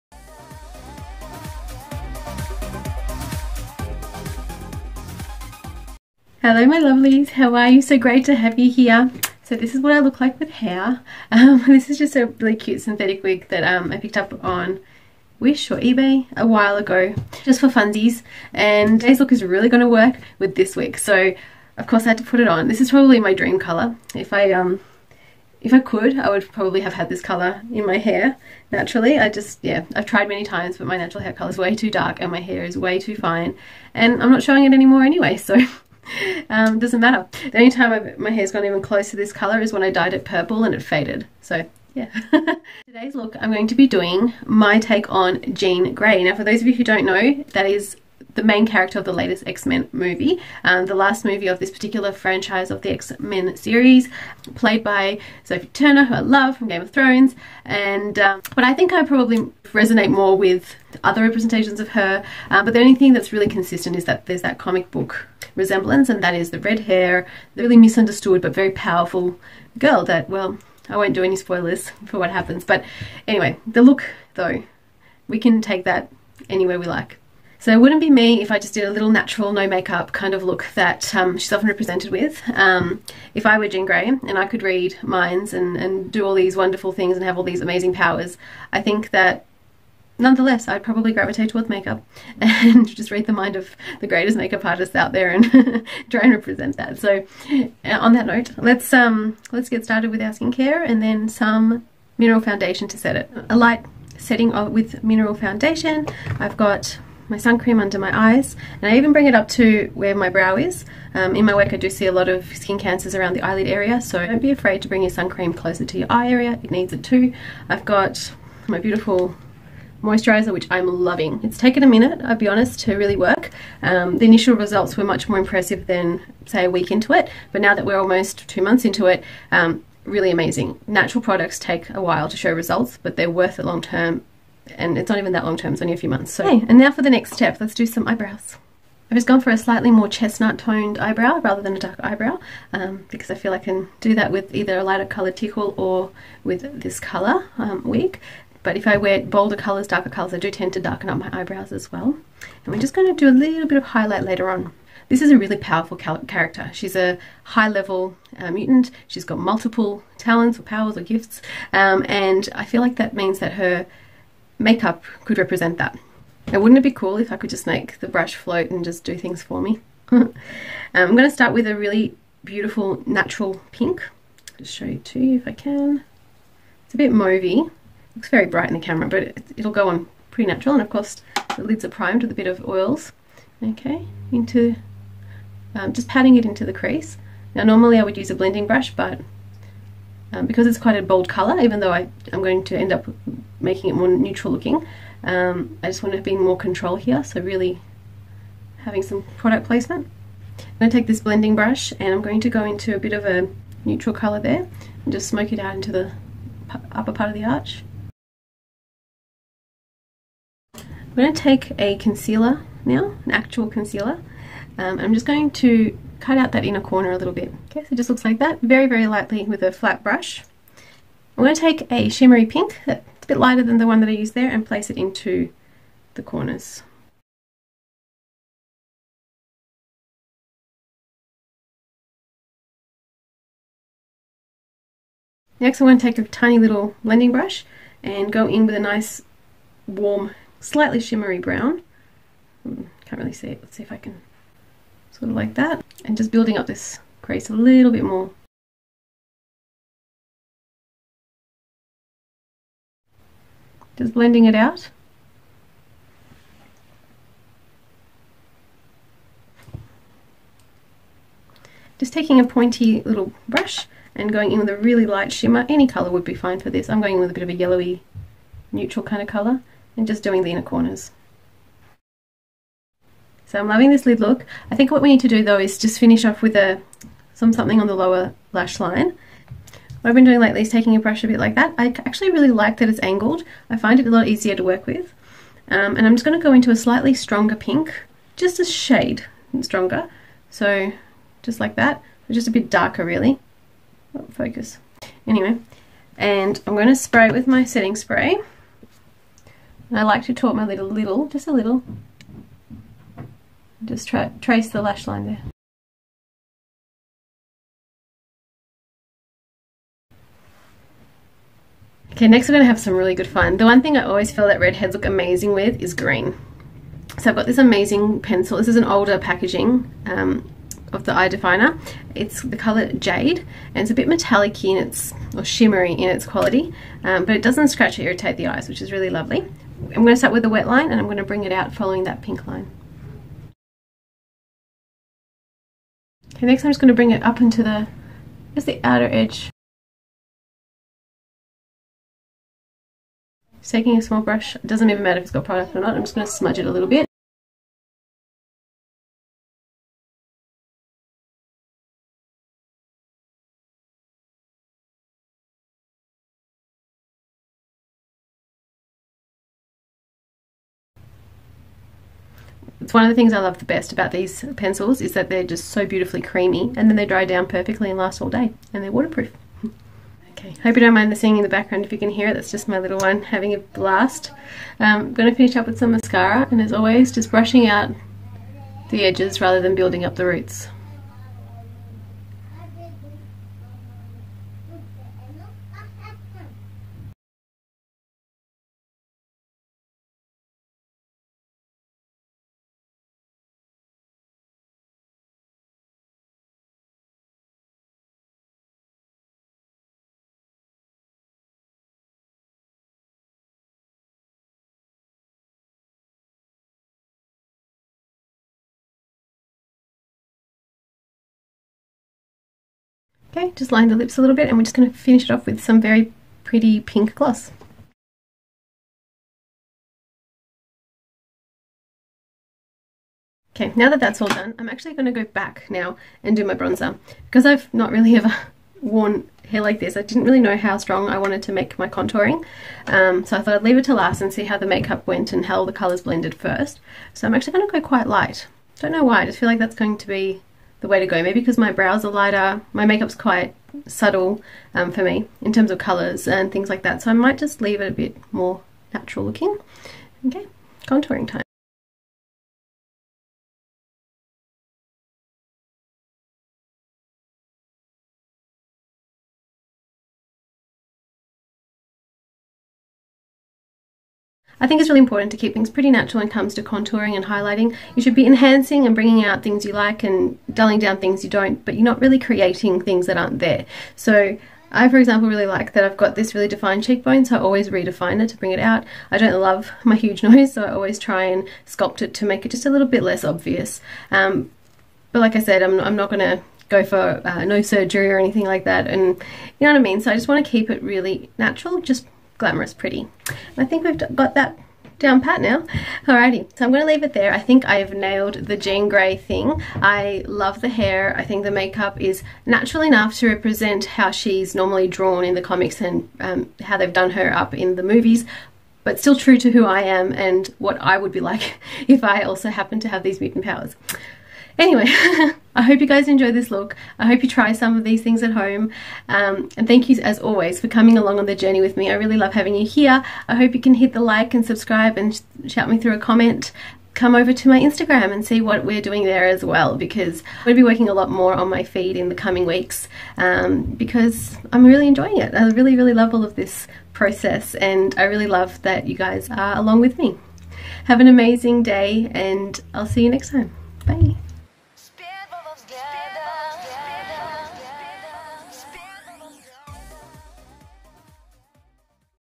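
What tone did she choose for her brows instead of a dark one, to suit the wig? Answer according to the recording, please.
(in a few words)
chestnut.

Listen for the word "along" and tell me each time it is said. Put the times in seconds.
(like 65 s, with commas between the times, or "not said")
520 s, 539 s.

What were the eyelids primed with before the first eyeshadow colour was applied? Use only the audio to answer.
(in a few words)
oils.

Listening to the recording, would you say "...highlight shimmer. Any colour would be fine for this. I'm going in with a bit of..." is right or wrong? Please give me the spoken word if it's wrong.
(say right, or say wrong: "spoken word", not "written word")
wrong: "light", not "highlight".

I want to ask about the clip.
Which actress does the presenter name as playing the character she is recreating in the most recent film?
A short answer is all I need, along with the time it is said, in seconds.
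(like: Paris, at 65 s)
Sophie Turner, at 55 s.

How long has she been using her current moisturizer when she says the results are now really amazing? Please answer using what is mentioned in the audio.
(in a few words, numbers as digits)
almost two months.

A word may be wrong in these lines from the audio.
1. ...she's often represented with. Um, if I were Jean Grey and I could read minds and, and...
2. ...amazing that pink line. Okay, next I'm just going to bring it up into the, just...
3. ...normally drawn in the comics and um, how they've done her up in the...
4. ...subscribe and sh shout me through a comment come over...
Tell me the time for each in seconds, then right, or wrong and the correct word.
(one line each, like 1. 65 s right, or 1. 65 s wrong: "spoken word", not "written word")
1. 81 s right
2. 331 s wrong: "following", not "amazing"
3. 504 s right
4. 524 s right.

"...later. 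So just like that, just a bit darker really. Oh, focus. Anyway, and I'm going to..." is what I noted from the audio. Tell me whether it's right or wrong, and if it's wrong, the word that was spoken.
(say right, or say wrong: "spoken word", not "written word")
wrong: "stronger", not "later".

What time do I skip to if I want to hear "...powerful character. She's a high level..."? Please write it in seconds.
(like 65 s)
155 s.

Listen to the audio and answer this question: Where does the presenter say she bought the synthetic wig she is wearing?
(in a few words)
Wish or eBay.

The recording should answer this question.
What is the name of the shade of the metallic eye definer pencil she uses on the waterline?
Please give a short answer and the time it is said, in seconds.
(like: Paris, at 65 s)
Jade, at 322 s.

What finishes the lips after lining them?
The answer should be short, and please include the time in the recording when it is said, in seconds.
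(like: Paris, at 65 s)
pink gloss, at 416 s.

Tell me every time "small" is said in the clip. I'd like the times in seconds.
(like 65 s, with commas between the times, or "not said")
344 s.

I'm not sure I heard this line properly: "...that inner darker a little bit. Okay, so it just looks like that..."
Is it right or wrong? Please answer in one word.
wrong.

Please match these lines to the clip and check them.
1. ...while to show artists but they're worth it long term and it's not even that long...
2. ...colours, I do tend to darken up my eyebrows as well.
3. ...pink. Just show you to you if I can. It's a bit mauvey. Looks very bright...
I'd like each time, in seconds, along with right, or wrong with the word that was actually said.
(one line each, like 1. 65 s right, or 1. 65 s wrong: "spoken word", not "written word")
1. 132 s wrong: "results", not "artists"
2. 150 s right
3. 173 s right.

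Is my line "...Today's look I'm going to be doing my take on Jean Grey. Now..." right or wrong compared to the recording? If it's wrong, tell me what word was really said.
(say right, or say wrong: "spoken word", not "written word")
right.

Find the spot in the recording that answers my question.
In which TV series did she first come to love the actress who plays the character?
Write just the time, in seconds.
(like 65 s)
56 s.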